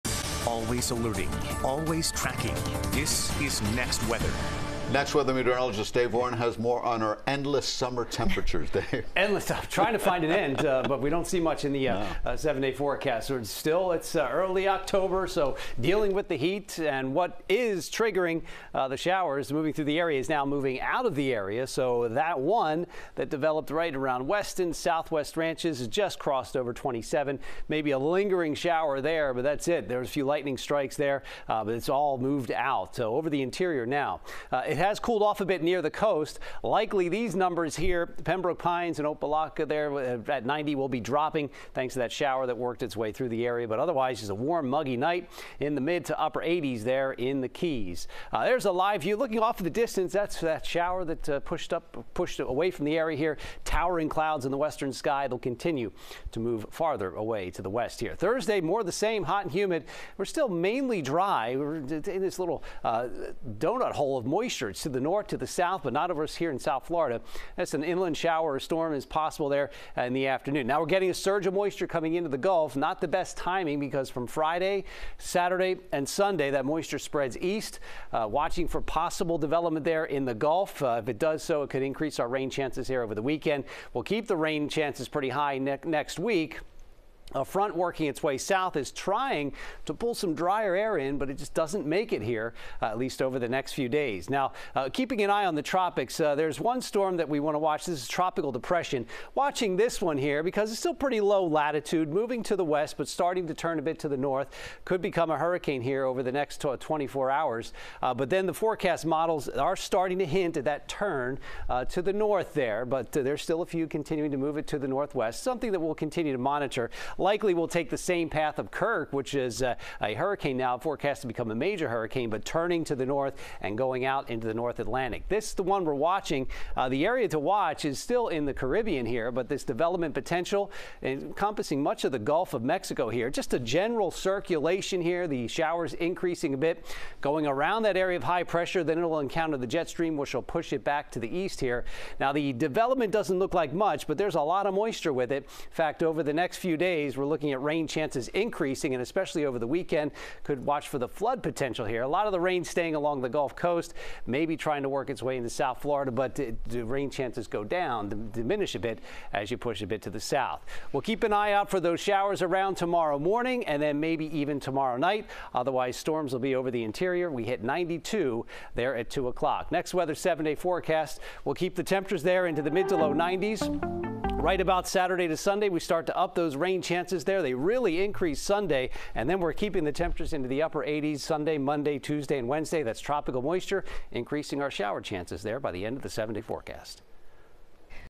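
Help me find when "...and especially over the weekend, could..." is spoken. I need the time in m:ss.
2:28.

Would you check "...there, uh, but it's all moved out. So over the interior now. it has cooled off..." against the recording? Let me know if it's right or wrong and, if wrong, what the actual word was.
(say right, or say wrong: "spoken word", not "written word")
right.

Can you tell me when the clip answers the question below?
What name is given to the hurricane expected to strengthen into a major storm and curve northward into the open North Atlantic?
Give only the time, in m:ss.
1:58.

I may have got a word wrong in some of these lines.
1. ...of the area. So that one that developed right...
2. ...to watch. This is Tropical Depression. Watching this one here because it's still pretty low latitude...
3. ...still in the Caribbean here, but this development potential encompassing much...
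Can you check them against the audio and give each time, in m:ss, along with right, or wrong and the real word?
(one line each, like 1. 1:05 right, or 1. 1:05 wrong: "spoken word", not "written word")
1. 0:21 right
2. 1:37 right
3. 2:07 right.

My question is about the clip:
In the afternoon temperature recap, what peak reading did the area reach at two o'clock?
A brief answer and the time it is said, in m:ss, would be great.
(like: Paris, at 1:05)
92, at 2:47.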